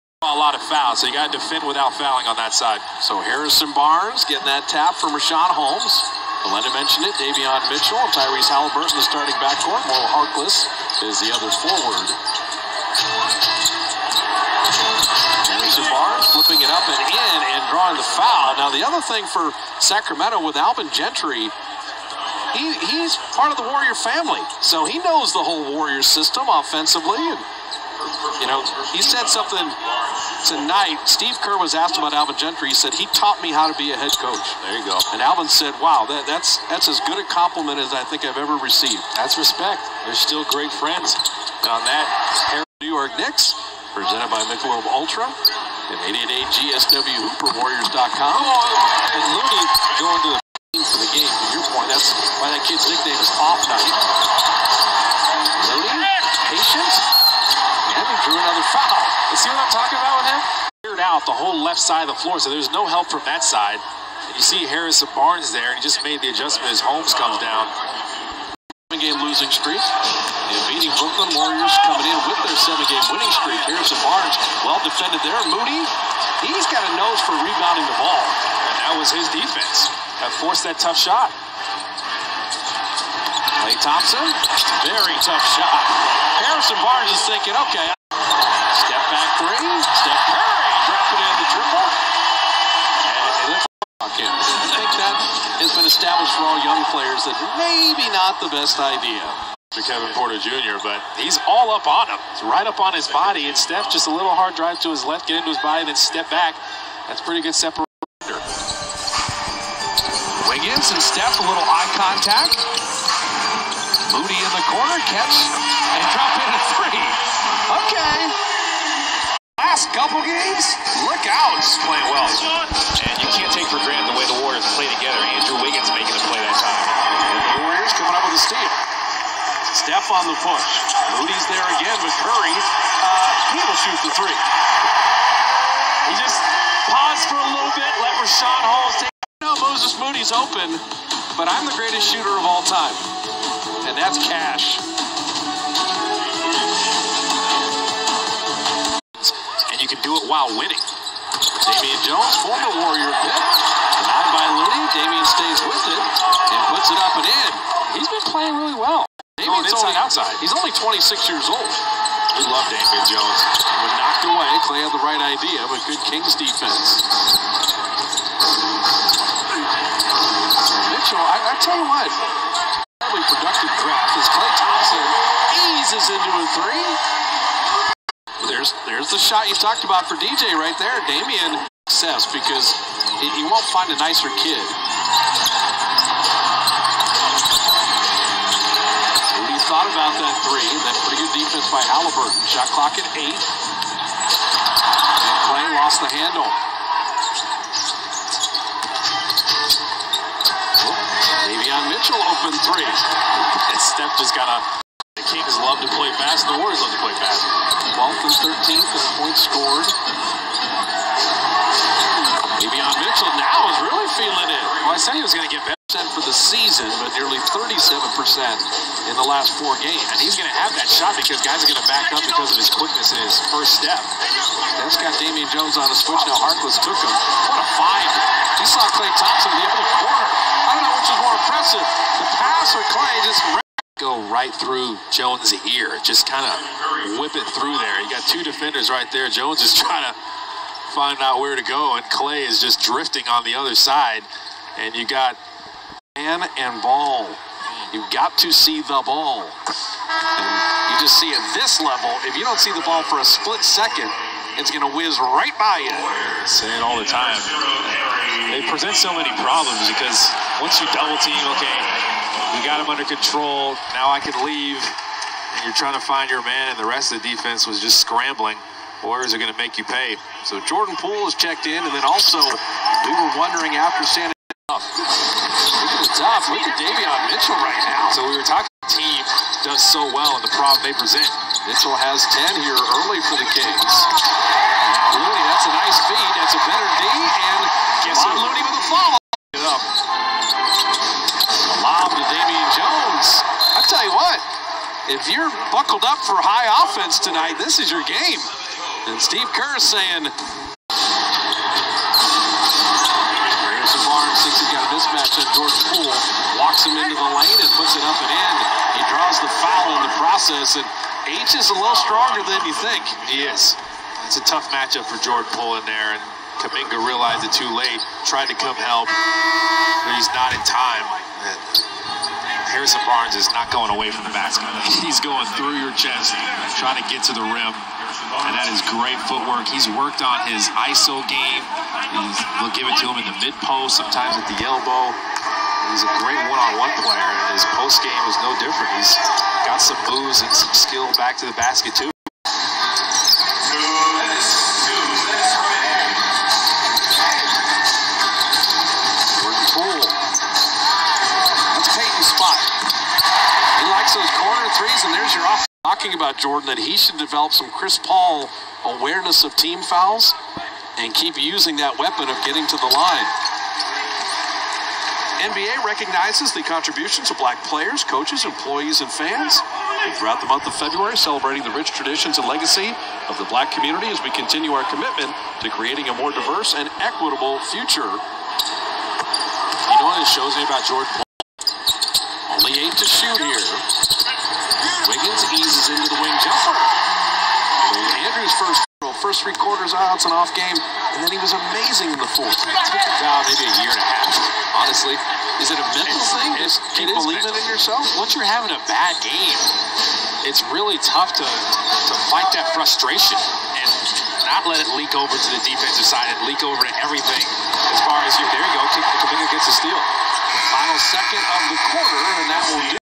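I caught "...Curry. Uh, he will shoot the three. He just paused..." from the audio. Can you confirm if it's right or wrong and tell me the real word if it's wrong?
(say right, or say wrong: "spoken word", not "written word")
right.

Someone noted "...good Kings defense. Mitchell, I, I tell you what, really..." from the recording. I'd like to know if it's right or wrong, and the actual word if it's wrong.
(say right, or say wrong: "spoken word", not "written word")
right.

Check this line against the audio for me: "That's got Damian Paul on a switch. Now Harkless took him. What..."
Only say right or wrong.
wrong.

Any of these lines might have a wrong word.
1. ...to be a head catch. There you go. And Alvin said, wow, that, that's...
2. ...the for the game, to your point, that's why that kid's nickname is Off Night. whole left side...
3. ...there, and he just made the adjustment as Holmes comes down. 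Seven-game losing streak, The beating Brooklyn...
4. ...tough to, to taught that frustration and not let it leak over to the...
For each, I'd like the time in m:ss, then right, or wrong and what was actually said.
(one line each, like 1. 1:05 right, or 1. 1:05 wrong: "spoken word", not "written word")
1. 0:33 wrong: "coach", not "catch"
2. 0:50 right
3. 1:05 right
4. 6:40 wrong: "fight", not "taught".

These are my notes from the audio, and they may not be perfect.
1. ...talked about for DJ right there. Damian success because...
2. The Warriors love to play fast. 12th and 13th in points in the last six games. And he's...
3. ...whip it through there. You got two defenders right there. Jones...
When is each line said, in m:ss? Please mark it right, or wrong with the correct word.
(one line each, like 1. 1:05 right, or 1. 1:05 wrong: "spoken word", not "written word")
1. 2:59 right
2. 3:26 wrong: "four", not "six"
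3. 3:57 right.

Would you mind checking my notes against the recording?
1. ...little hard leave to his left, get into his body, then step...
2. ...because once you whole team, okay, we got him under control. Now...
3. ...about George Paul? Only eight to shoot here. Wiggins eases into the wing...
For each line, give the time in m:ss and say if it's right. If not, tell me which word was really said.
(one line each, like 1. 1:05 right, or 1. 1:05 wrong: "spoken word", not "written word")
1. 1:44 wrong: "drive", not "leave"
2. 4:19 wrong: "double", not "whole"
3. 6:20 right.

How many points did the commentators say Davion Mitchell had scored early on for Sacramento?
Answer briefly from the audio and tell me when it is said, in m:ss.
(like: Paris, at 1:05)
10, at 4:42.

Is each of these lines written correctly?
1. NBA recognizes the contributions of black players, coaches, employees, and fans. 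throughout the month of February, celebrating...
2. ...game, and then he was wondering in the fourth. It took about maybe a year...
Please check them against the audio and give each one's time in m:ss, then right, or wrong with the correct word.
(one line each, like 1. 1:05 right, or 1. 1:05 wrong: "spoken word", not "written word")
1. 6:05 right
2. 6:30 wrong: "amazing", not "wondering".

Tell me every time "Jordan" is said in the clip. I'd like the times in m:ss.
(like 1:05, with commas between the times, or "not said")
4:30, 5:56.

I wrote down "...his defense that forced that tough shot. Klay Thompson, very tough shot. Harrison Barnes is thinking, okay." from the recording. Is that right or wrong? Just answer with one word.
right.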